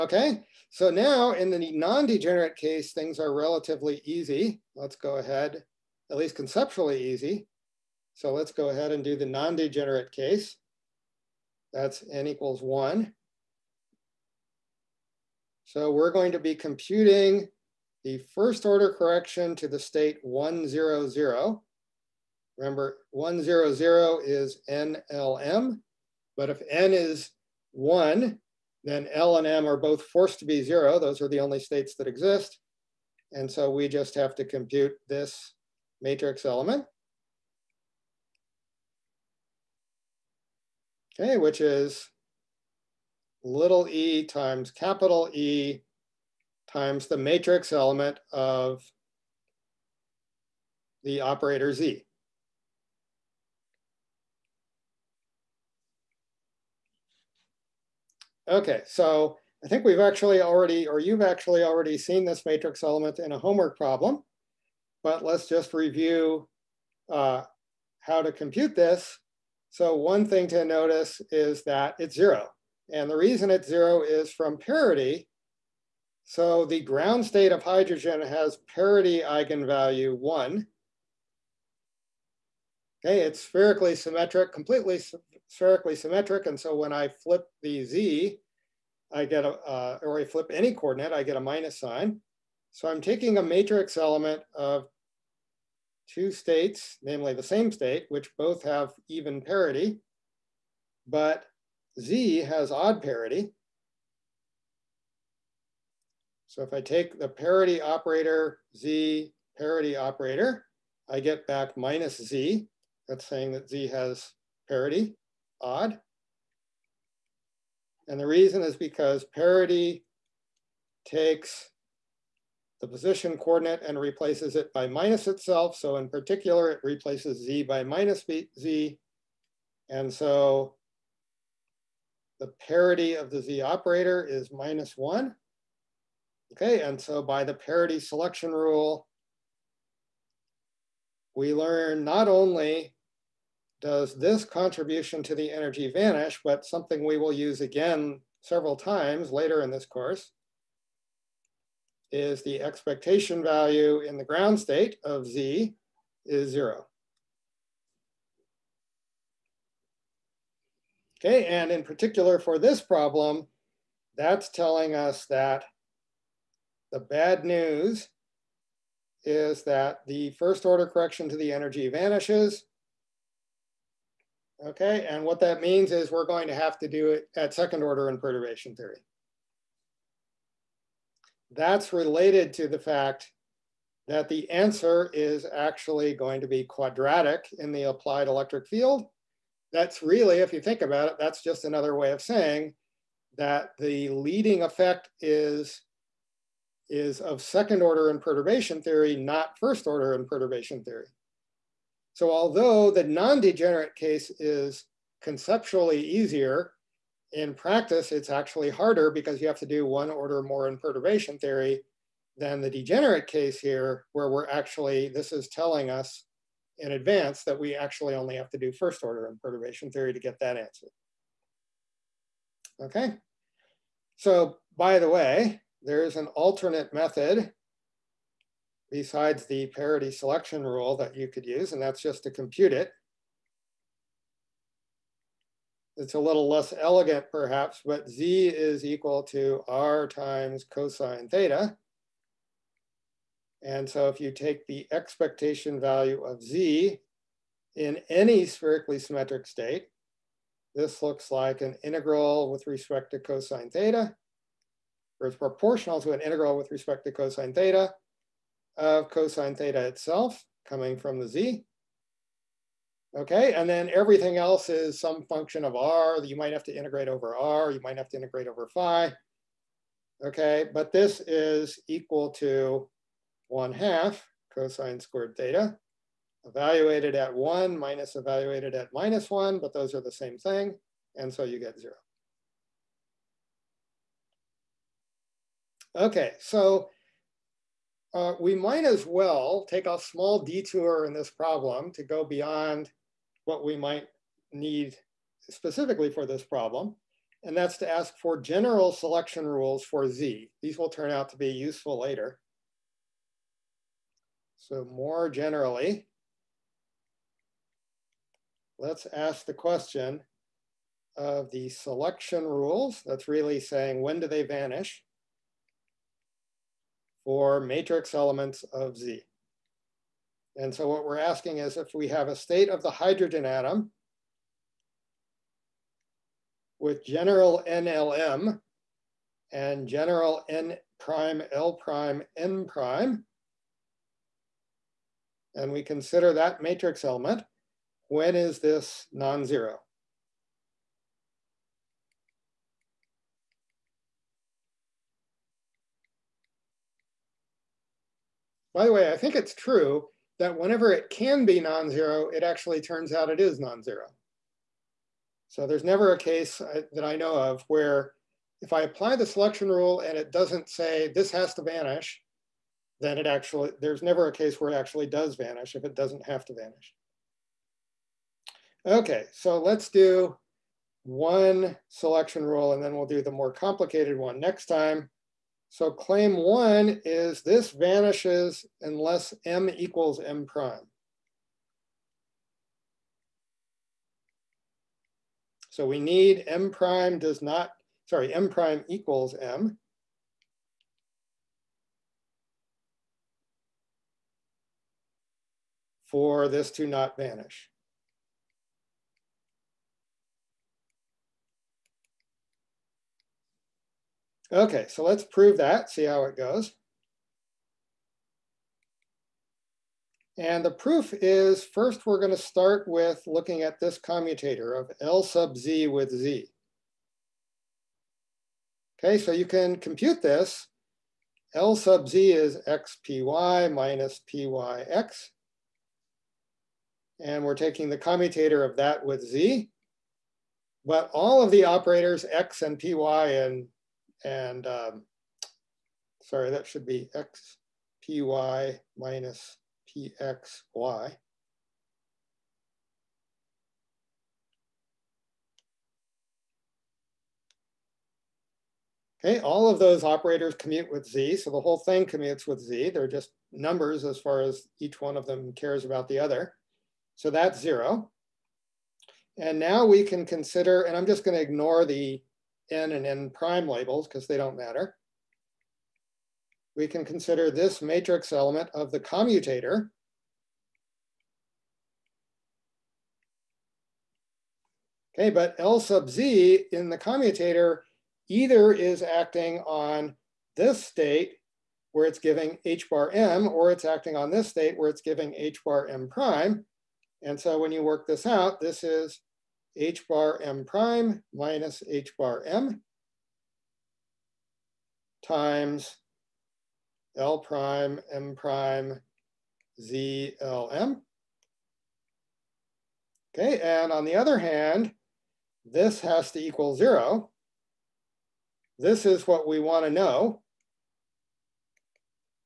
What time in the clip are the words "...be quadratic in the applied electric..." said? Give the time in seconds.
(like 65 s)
186 s.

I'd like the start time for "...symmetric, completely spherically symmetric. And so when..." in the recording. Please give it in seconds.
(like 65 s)
83 s.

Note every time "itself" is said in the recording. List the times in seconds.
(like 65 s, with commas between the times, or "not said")
125 s, 259 s.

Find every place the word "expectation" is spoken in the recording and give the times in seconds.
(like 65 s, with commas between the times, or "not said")
152 s, 244 s.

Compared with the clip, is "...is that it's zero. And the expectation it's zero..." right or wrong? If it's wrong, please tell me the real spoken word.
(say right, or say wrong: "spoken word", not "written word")
wrong: "reason", not "expectation".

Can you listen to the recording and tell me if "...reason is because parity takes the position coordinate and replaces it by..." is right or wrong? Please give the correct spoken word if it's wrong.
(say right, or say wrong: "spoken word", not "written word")
right.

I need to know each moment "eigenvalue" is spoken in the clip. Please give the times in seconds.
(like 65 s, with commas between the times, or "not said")
79 s.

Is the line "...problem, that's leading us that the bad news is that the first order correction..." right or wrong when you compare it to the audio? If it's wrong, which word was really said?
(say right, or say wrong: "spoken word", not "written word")
wrong: "telling", not "leading".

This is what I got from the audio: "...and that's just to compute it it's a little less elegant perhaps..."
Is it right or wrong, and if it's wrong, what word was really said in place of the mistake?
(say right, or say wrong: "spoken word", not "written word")
right.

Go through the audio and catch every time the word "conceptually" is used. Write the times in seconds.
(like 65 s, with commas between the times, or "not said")
6 s, 205 s.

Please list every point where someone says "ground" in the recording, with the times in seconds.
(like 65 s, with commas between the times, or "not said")
76 s, 154 s.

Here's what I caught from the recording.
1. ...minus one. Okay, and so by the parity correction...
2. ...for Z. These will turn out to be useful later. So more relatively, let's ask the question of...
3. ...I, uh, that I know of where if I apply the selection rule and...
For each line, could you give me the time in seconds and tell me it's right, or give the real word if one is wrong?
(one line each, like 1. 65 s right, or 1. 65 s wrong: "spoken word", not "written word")
1. 134 s wrong: "selection", not "correction"
2. 299 s wrong: "generally", not "relatively"
3. 356 s right.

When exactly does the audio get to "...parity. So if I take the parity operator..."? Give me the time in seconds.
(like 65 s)
103 s.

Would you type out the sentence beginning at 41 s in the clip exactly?
okay, which is little e times capital E times the matrix element of the operator Z.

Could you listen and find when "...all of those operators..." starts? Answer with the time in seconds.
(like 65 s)
449 s.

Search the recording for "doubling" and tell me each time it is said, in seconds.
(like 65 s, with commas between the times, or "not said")
not said.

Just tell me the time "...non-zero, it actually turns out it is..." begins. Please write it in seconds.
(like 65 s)
351 s.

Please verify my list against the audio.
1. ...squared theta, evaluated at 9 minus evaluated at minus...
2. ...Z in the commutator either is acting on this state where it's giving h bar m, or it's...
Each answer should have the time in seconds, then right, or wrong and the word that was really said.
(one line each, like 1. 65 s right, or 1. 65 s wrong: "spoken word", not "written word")
1. 275 s wrong: "1", not "9"
2. 476 s right.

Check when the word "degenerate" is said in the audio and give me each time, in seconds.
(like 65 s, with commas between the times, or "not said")
1 s, 9 s, 203 s, 212 s.